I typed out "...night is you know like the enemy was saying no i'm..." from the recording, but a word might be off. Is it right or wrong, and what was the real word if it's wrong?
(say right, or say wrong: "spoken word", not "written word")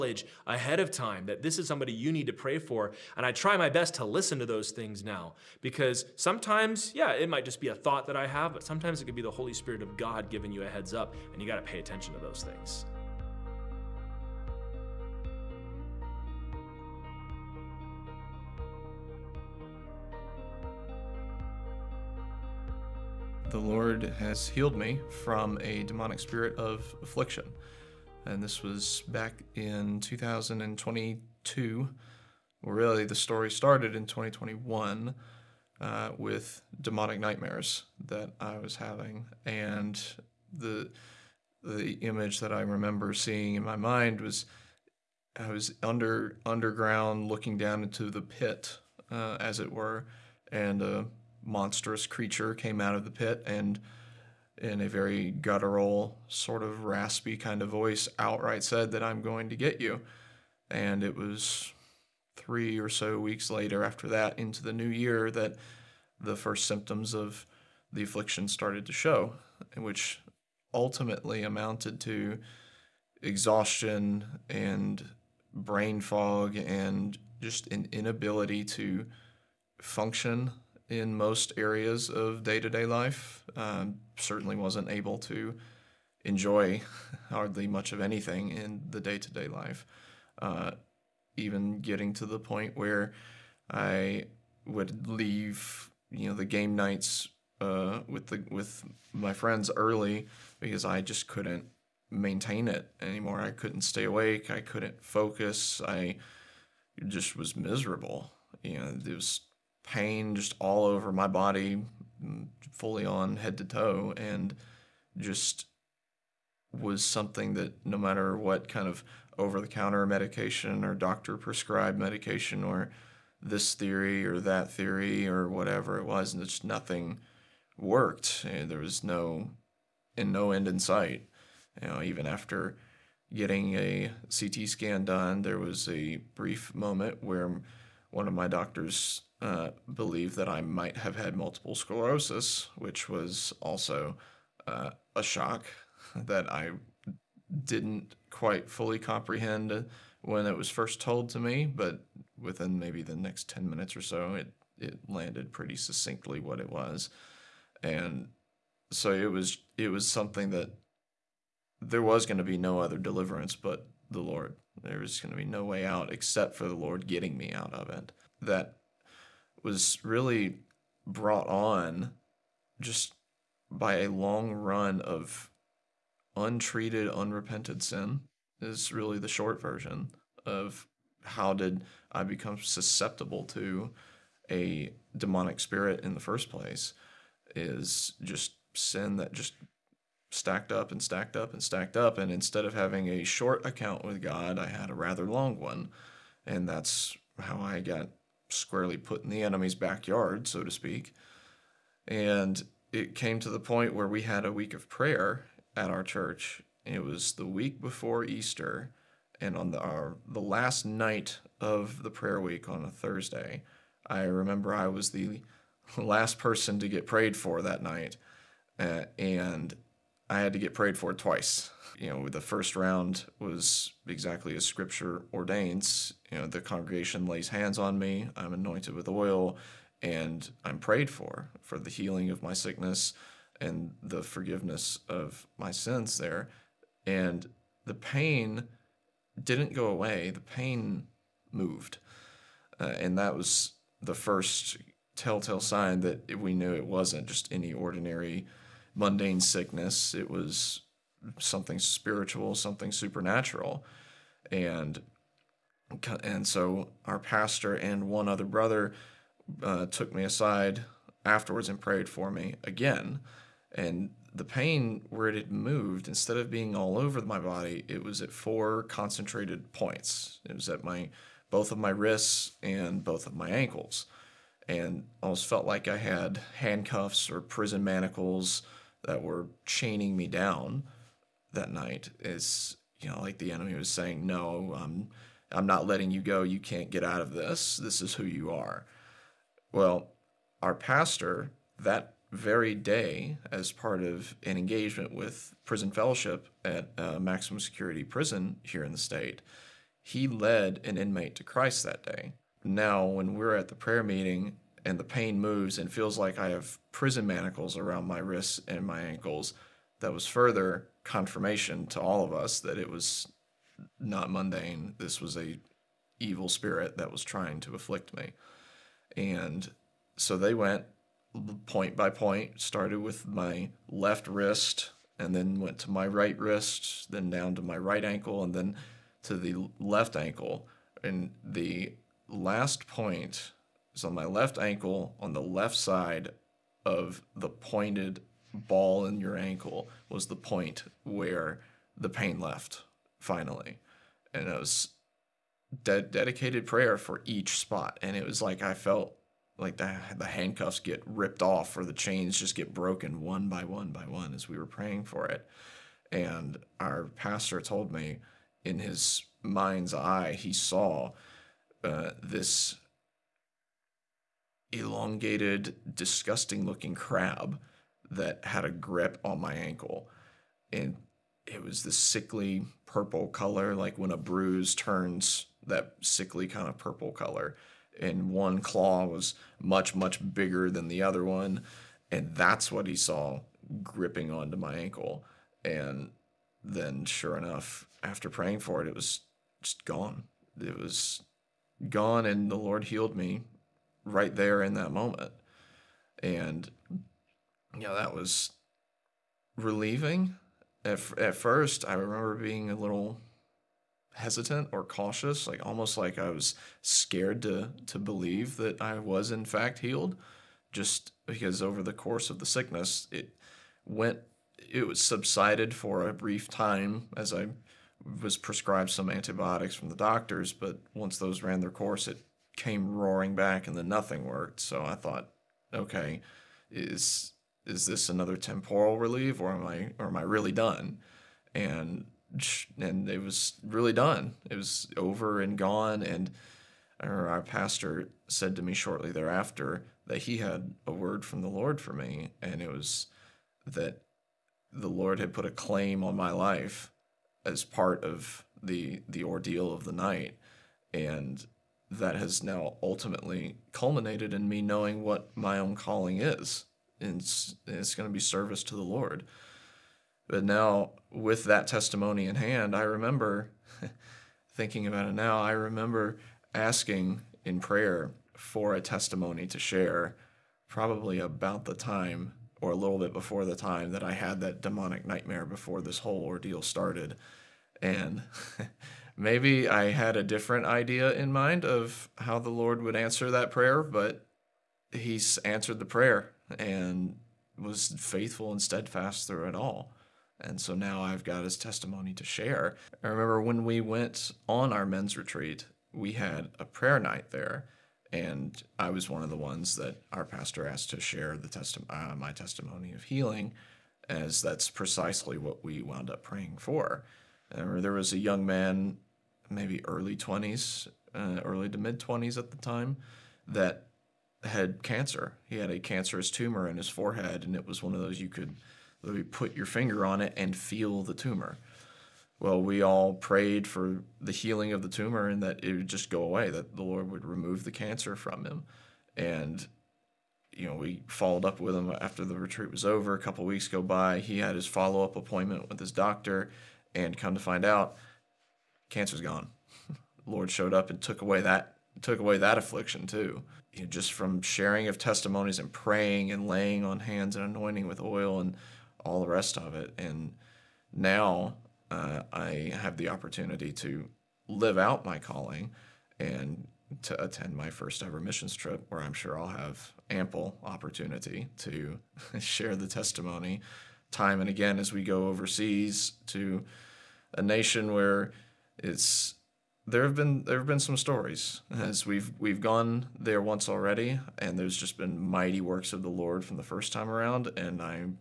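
right.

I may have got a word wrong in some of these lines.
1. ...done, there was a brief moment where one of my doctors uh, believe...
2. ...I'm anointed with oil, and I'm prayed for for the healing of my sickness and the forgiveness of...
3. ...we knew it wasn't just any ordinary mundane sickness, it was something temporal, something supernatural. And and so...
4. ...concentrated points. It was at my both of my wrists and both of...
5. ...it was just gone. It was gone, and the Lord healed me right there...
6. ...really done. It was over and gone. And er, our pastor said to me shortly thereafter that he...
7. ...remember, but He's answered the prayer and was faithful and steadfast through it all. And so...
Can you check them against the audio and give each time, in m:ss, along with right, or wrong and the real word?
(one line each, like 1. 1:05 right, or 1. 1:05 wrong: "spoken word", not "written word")
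1. 2:15 right
2. 3:48 right
3. 4:06 wrong: "spiritual", not "temporal"
4. 4:28 right
5. 6:28 right
6. 7:13 right
7. 8:03 wrong: "prayer", not "remember".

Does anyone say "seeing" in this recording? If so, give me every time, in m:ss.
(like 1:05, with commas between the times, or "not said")
0:43.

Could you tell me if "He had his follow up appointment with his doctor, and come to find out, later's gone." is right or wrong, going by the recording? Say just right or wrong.
wrong.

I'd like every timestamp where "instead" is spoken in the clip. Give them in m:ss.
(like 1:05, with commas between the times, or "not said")
3:12, 4:26.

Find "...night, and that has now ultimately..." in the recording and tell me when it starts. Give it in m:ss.
7:29.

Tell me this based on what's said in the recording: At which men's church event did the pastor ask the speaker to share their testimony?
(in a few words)
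men's retreat.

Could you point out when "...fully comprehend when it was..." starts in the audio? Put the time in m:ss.
2:28.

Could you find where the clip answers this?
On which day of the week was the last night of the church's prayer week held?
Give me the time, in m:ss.
3:32.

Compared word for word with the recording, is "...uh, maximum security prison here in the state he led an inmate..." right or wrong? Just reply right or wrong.
right.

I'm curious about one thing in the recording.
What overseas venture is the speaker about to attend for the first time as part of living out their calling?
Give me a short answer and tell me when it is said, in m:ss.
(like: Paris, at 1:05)
missions trip, at 9:18.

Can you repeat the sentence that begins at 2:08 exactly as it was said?
there was no and no end in sight.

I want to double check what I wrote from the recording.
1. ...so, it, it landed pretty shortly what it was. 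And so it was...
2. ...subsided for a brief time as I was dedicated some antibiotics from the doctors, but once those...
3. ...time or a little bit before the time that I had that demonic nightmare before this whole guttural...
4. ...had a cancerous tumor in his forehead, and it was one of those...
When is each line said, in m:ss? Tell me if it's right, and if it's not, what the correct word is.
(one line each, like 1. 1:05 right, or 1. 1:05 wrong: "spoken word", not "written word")
1. 2:34 wrong: "succinctly", not "shortly"
2. 6:55 wrong: "prescribed", not "dedicated"
3. 7:51 wrong: "ordeal", not "guttural"
4. 8:35 right.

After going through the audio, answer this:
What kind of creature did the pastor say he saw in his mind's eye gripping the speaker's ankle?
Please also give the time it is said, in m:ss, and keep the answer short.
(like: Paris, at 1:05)
crab, at 6:06.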